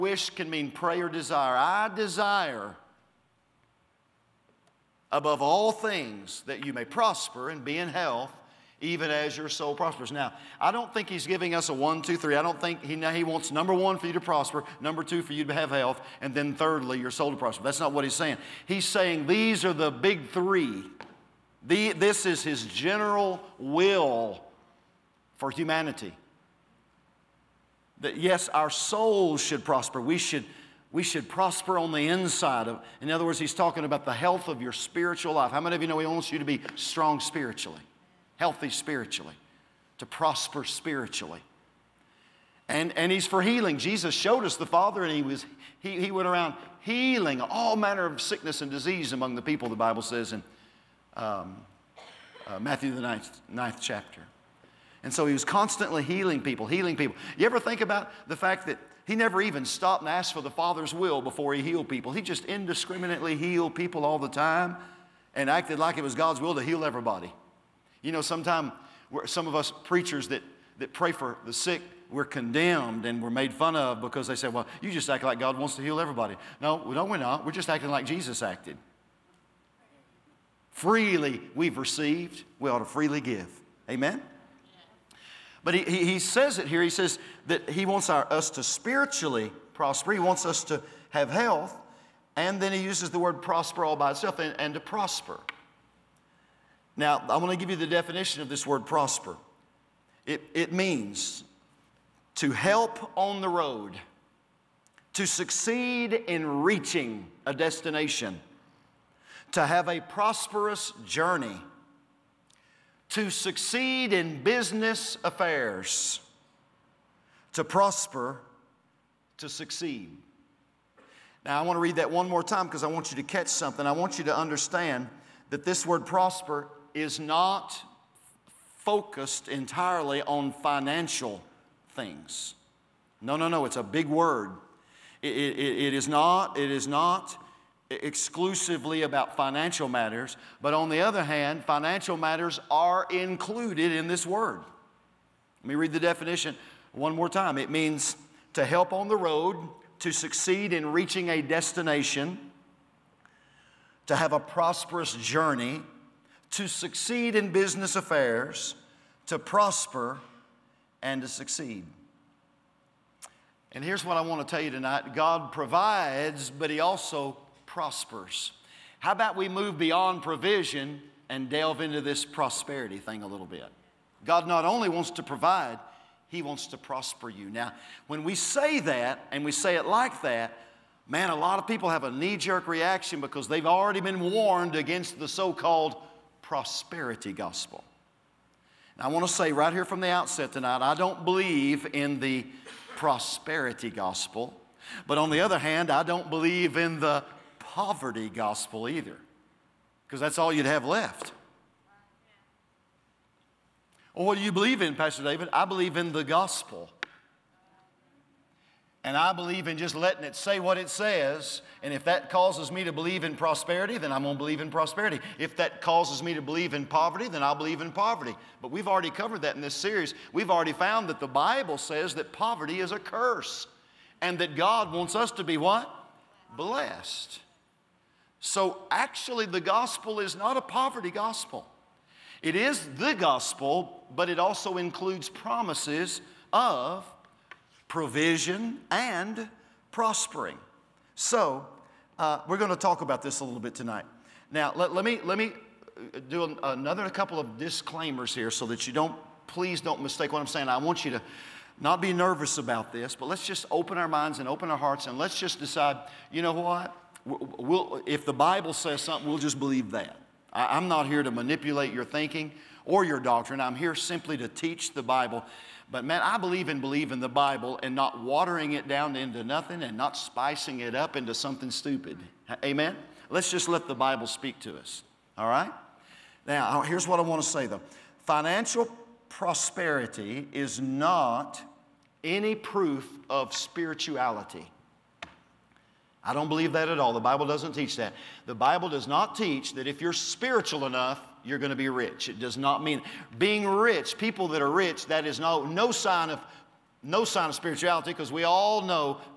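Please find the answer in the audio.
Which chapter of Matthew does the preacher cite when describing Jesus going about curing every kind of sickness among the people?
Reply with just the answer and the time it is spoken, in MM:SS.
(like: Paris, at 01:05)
ninth chapter, at 00:52.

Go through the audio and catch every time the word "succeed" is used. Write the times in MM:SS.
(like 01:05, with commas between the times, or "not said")
01:45, 01:53, 01:59, 02:30, 02:36, 02:41.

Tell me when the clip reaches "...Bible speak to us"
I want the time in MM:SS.
04:33.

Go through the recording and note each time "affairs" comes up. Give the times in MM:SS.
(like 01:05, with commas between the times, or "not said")
01:55, 02:37.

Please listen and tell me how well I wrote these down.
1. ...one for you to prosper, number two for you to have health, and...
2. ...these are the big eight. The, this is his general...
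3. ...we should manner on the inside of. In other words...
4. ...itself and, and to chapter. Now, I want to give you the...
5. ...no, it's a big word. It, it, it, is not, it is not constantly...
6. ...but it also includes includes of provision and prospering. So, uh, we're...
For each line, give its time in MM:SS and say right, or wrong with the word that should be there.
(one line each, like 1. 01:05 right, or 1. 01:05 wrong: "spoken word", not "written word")
1. 00:13 right
2. 00:19 wrong: "three", not "eight"
3. 00:30 wrong: "prosper", not "manner"
4. 01:34 wrong: "prosper", not "chapter"
5. 02:13 wrong: "exclusively", not "constantly"
6. 03:54 wrong: "promises", not "includes".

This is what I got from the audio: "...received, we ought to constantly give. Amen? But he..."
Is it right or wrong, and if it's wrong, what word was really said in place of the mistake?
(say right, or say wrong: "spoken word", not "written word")
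wrong: "freely", not "constantly".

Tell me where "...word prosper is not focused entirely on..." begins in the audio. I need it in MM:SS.
02:05.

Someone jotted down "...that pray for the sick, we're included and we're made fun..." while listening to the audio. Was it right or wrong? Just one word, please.
wrong.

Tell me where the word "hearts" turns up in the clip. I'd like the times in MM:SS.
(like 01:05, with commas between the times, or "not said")
04:14.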